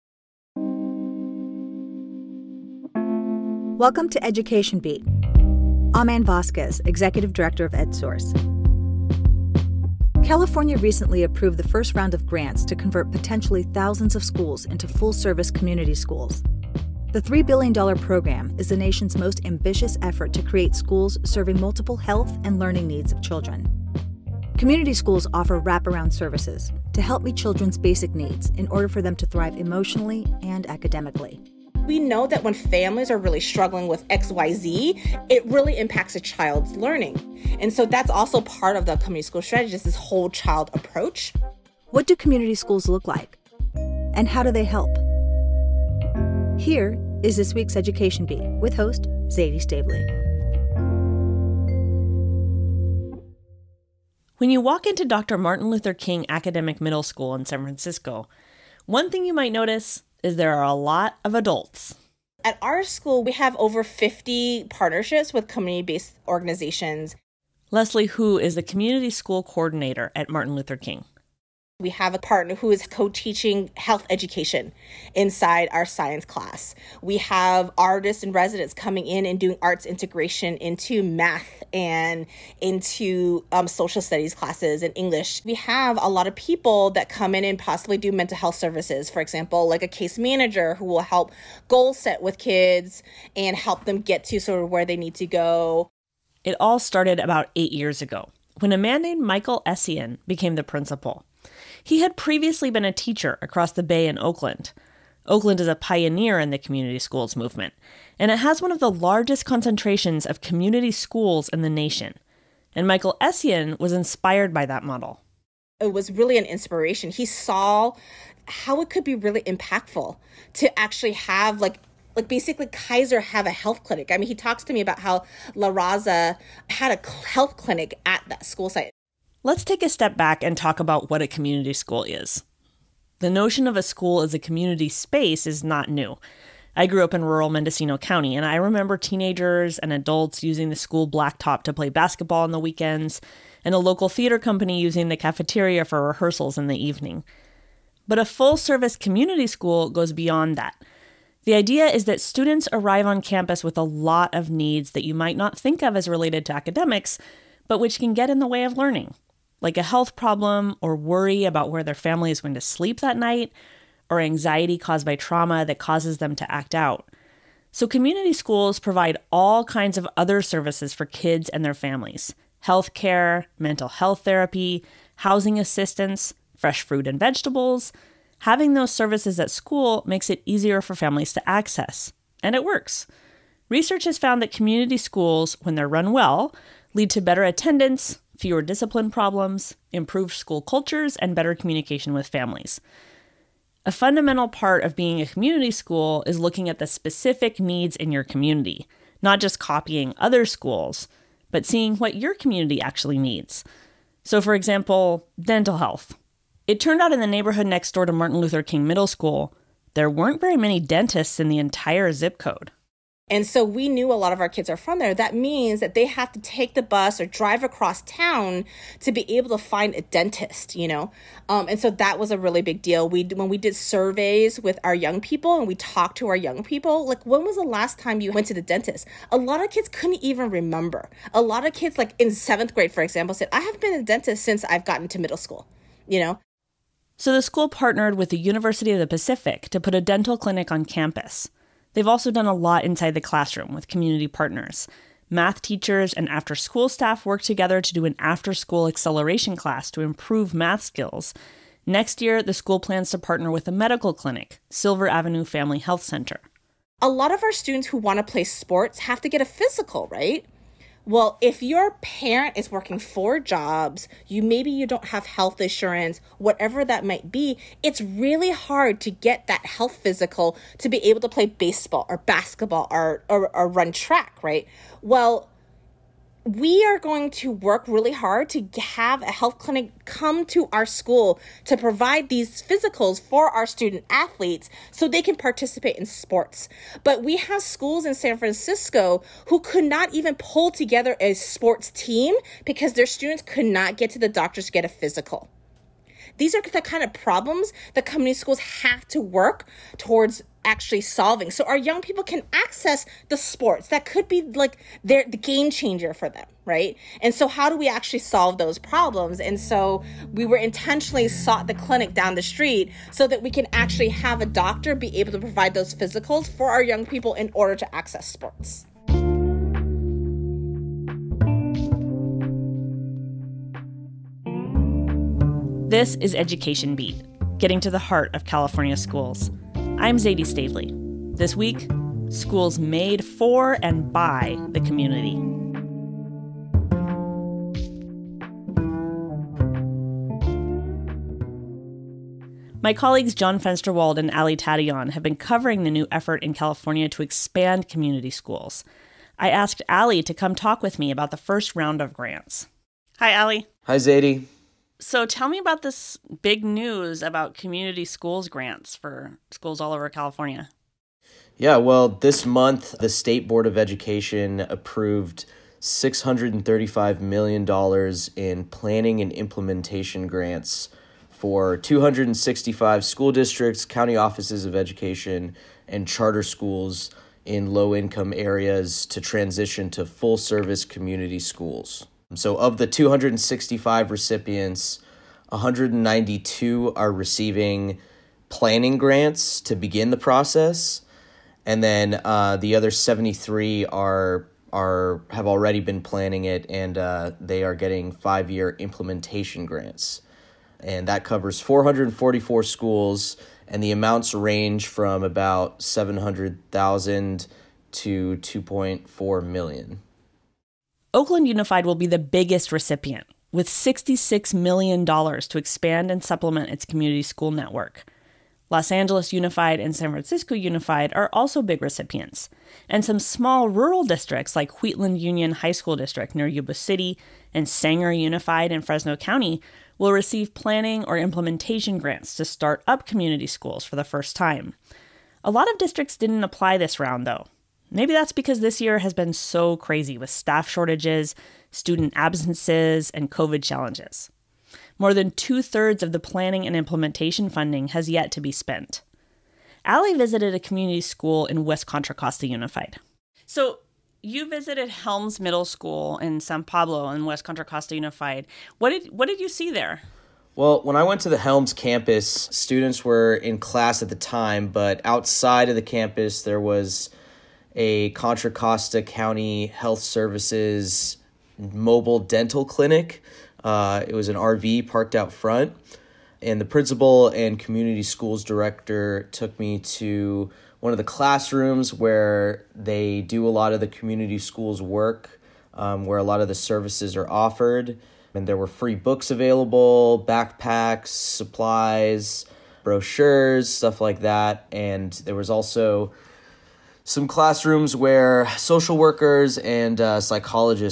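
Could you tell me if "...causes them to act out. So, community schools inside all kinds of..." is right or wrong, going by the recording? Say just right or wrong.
wrong.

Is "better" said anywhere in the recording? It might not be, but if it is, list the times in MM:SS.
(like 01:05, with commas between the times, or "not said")
03:07, 03:11.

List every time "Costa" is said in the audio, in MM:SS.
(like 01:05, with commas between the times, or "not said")
07:32, 07:37, 07:48.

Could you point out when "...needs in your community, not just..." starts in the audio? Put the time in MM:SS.
03:17.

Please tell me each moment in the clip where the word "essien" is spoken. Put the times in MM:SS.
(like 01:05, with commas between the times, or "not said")
01:39, 01:53.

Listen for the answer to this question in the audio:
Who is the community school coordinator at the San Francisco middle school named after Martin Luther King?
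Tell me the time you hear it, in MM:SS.
01:07.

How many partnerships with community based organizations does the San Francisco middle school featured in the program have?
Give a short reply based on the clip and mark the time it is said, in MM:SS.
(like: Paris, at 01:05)
over 50, at 01:03.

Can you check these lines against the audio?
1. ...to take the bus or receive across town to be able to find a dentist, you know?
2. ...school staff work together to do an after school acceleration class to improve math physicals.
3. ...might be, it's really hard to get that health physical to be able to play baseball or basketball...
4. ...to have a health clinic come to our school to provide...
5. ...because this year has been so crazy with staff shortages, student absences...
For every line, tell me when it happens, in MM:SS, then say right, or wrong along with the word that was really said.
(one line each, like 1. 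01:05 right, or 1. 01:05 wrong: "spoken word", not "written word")
1. 03:36 wrong: "drive", not "receive"
2. 04:06 wrong: "skills", not "physicals"
3. 04:27 right
4. 04:38 right
5. 07:18 right.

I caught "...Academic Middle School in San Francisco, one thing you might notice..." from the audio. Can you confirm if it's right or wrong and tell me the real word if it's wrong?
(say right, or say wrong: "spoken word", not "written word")
right.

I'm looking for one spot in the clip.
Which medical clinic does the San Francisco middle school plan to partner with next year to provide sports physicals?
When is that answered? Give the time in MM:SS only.
04:14.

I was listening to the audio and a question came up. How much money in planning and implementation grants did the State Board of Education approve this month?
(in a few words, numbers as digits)
$635 million.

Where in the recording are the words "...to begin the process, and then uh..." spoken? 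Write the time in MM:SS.
06:29.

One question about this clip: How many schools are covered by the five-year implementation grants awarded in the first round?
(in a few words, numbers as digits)
444.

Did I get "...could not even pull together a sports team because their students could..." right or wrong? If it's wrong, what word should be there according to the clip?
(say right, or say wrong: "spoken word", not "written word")
right.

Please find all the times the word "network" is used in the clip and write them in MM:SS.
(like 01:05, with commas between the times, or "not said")
06:57.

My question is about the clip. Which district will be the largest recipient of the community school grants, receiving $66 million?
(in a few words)
Oakland Unified.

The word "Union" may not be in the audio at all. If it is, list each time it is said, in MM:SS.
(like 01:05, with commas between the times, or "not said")
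07:05.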